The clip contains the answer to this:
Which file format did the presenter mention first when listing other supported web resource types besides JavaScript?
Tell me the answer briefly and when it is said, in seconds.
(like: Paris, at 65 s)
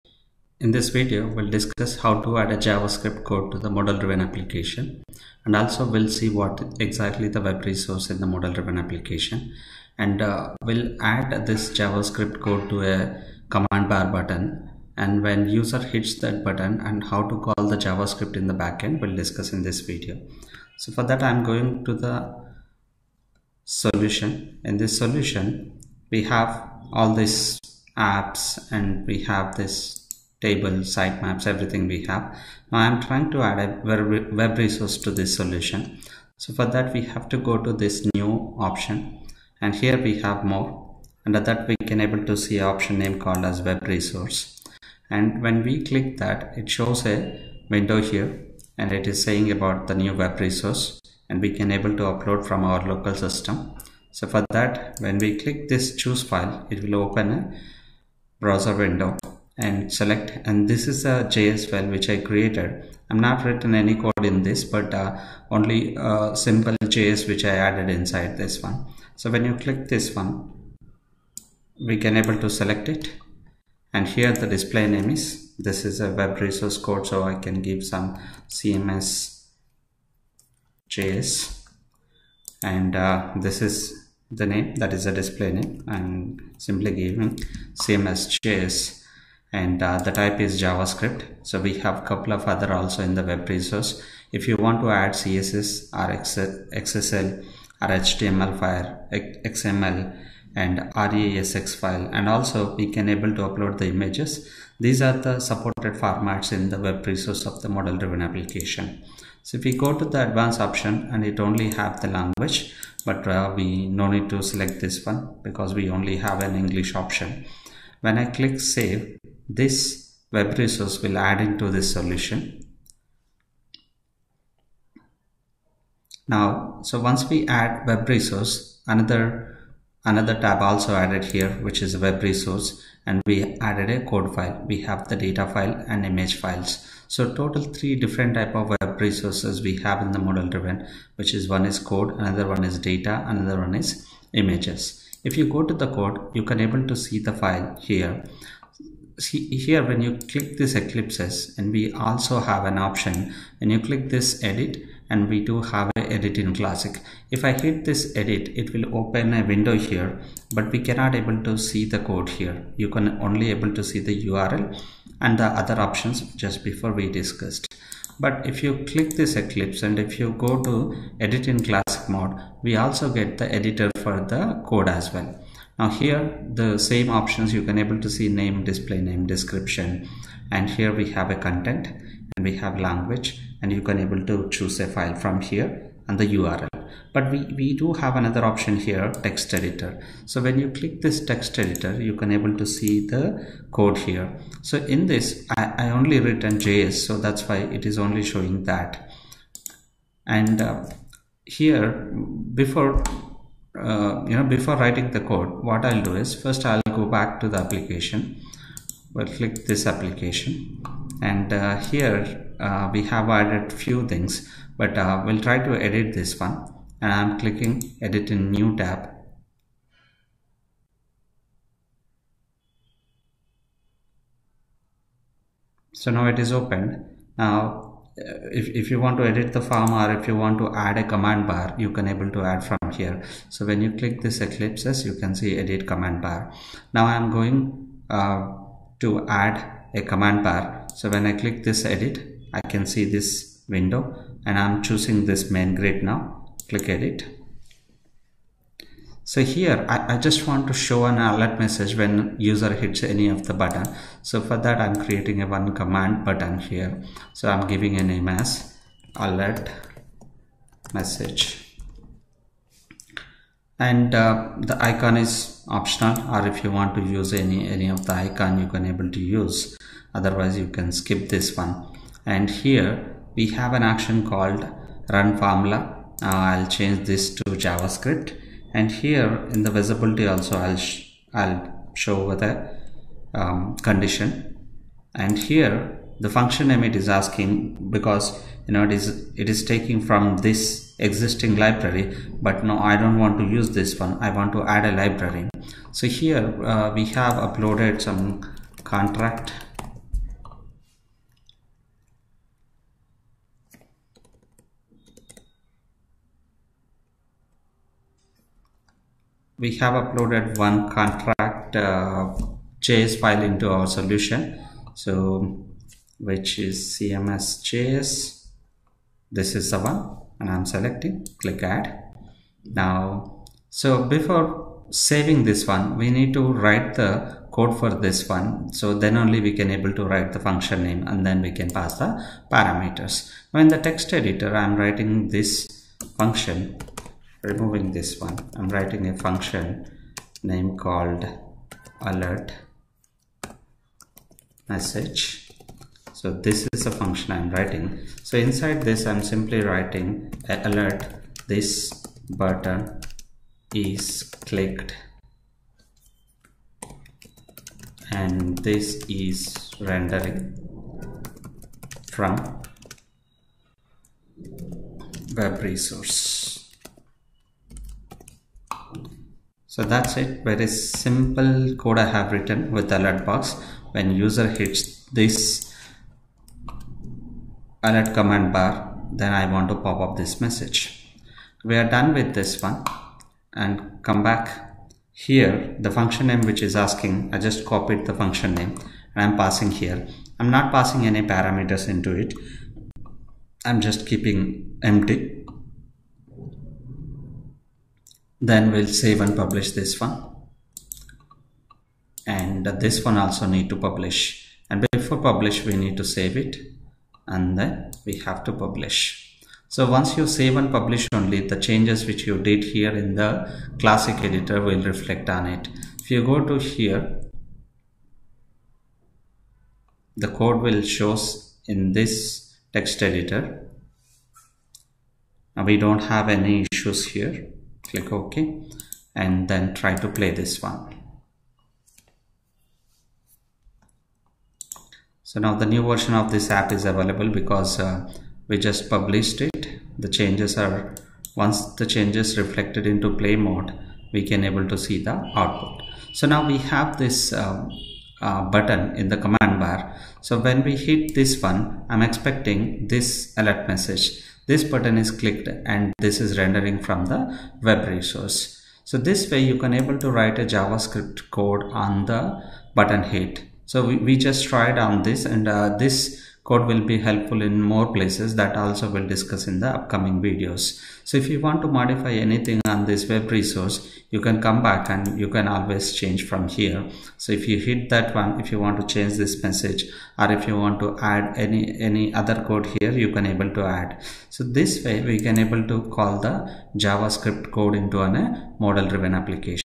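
css, at 95 s.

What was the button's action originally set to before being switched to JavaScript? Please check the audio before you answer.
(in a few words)
run formula.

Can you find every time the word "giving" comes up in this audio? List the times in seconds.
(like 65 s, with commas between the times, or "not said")
86 s, 257 s.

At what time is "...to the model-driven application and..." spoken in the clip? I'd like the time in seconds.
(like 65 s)
3 s.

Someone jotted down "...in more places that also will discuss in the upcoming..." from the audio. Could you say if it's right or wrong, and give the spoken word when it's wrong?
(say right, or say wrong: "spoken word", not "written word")
right.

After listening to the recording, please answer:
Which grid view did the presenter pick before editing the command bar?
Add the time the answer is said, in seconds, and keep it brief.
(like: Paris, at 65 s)
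main grid, at 245 s.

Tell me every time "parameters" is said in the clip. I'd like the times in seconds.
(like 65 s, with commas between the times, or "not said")
332 s, 391 s.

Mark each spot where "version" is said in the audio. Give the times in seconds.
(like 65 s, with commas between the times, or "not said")
435 s.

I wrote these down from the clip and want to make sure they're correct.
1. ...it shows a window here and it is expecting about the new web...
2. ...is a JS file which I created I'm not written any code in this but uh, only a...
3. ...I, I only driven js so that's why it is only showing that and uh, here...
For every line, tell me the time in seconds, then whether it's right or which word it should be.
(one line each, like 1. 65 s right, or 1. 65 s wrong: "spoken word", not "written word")
1. 46 s wrong: "saying", not "expecting"
2. 60 s right
3. 195 s wrong: "written", not "driven".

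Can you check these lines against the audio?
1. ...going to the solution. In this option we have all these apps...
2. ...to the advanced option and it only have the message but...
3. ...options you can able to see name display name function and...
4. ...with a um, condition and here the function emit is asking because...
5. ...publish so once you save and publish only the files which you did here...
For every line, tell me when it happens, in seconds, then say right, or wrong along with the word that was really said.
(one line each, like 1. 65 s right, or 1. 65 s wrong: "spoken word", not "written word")
1. 21 s wrong: "solution", not "option"
2. 109 s wrong: "language", not "message"
3. 177 s wrong: "description", not "function"
4. 282 s right
5. 408 s wrong: "changes", not "files".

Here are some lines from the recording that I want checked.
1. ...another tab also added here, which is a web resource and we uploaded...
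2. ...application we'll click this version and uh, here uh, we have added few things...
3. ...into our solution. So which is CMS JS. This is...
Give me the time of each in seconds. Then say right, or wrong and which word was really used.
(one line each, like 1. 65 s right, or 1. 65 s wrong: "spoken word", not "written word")
1. 130 s wrong: "added", not "uploaded"
2. 207 s wrong: "application", not "version"
3. 313 s right.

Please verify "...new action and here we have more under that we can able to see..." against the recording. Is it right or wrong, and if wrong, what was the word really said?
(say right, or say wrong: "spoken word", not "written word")
wrong: "option", not "action".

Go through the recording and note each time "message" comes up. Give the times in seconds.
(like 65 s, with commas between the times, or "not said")
251 s, 260 s, 344 s, 380 s, 453 s, 479 s.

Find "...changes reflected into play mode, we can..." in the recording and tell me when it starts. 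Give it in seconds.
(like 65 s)
441 s.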